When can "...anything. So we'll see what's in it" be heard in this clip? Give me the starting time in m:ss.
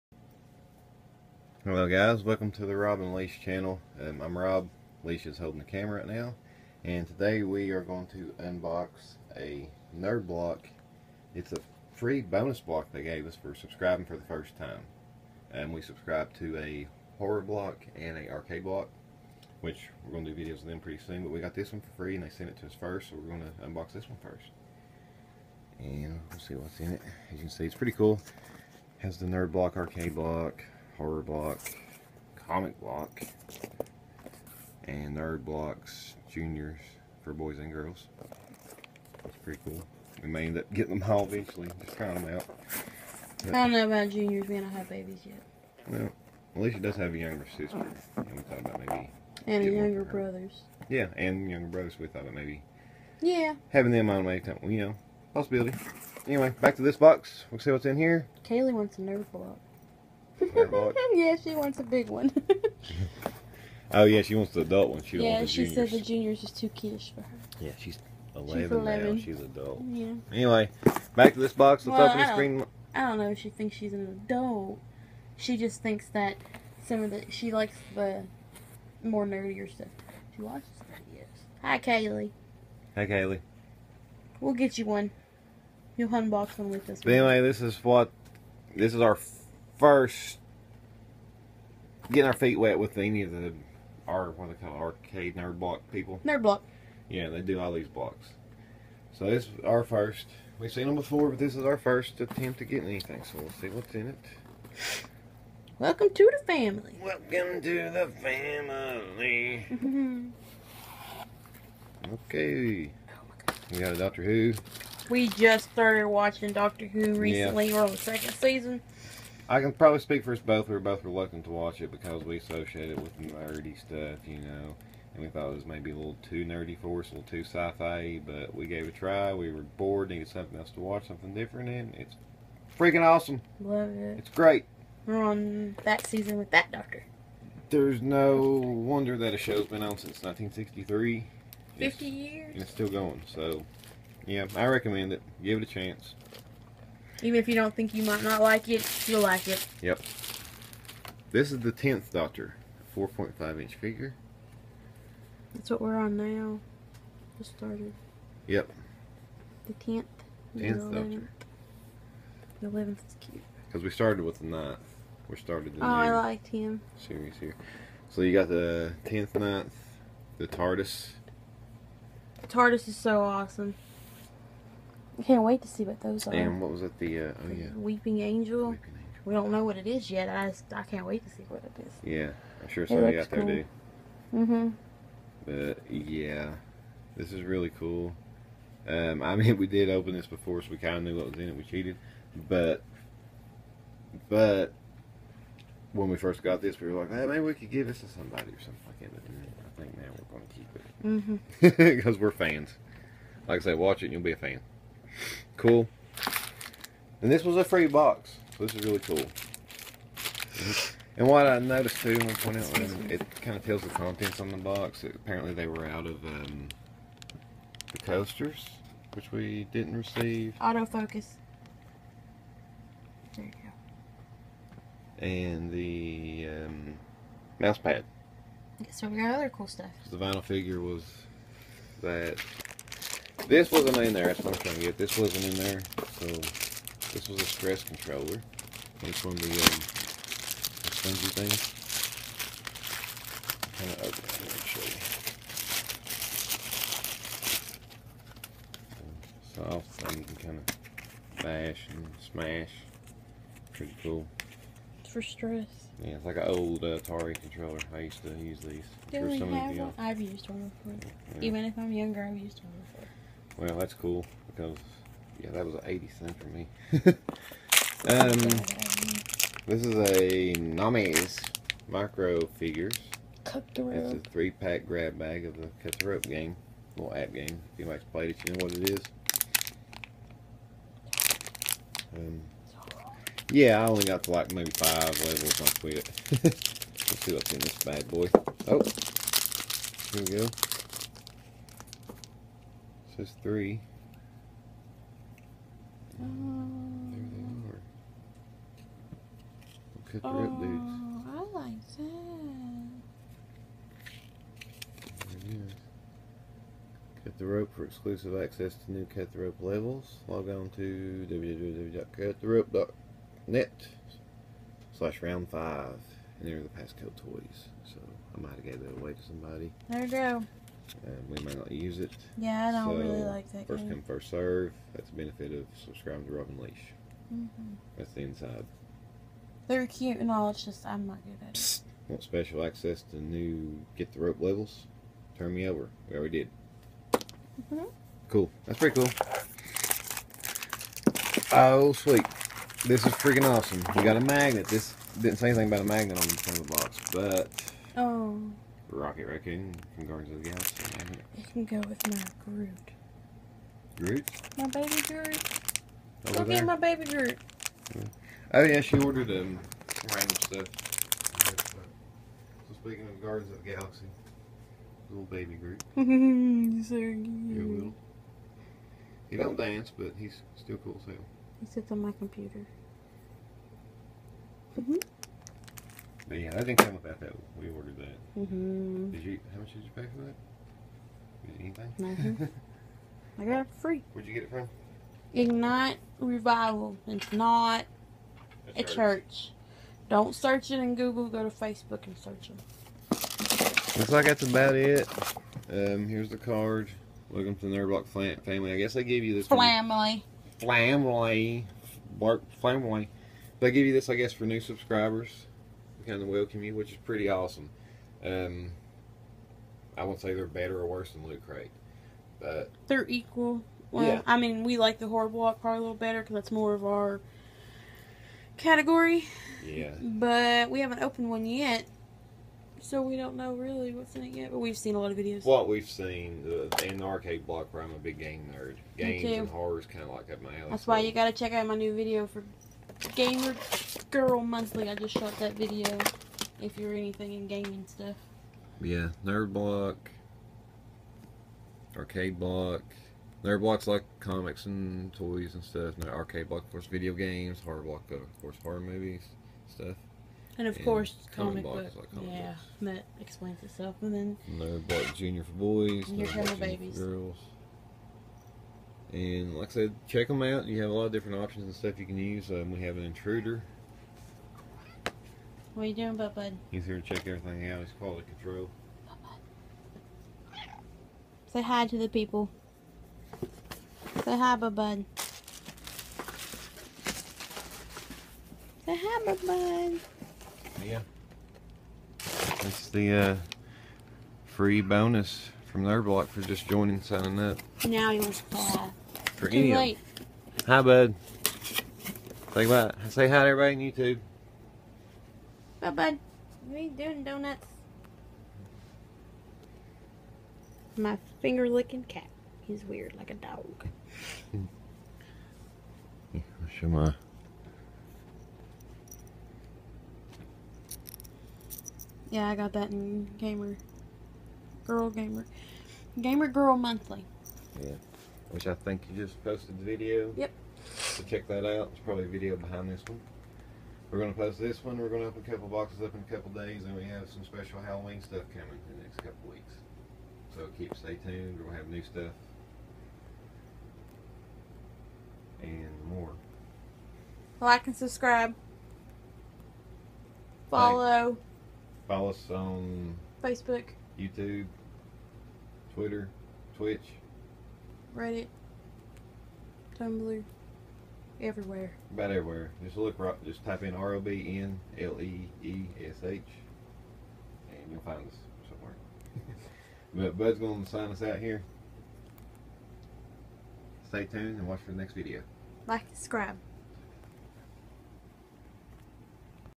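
1:42.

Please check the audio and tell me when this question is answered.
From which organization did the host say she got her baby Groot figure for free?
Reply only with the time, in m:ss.
6:25.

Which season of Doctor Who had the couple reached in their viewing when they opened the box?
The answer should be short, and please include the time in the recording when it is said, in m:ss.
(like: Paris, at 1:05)
second season, at 1:57.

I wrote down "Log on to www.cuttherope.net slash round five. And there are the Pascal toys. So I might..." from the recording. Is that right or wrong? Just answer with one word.
right.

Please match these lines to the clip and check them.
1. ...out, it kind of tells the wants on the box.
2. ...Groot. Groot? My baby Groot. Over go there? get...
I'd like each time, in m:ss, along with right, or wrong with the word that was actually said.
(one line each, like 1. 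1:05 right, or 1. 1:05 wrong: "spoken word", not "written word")
1. 3:32 wrong: "contents", not "wants"
2. 5:52 right.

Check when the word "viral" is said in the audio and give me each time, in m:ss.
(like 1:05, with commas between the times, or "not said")
not said.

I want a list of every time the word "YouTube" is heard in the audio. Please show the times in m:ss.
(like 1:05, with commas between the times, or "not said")
8:13, 9:04.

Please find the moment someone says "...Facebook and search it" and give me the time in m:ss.
6:31.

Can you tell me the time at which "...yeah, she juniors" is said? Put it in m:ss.
1:05.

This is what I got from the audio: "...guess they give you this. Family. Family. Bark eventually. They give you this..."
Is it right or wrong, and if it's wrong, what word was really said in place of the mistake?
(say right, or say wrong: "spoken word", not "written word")
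wrong: "family", not "eventually".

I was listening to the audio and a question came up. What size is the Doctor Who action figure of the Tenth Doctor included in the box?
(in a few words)
4.5 inch.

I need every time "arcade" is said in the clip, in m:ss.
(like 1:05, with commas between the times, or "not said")
0:18, 0:29, 1:34, 7:07, 7:21, 7:26.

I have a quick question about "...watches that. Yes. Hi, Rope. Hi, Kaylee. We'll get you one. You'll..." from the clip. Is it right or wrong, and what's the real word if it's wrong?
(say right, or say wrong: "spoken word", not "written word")
wrong: "Kaylee", not "Rope".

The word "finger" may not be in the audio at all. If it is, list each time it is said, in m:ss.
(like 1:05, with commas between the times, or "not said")
8:21.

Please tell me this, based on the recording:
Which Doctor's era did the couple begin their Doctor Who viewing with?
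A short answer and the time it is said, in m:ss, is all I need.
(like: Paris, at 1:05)
9th, at 2:44.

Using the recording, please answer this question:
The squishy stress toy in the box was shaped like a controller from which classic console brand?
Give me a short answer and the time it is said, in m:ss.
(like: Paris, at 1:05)
Atari, at 4:16.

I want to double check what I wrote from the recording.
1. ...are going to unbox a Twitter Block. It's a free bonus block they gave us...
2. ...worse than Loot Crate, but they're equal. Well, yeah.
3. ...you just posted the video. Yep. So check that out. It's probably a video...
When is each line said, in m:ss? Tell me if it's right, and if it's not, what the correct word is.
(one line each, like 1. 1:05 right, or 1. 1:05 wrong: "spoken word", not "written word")
1. 0:07 wrong: "Nerd", not "Twitter"
2. 6:50 right
3. 8:39 right.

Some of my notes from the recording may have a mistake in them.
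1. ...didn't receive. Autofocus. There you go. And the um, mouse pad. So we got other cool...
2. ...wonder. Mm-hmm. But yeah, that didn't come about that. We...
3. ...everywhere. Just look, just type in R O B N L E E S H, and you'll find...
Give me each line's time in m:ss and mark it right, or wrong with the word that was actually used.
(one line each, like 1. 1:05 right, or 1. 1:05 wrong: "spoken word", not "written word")
1. 3:39 right
2. 6:12 wrong: "computer", not "wonder"
3. 9:12 right.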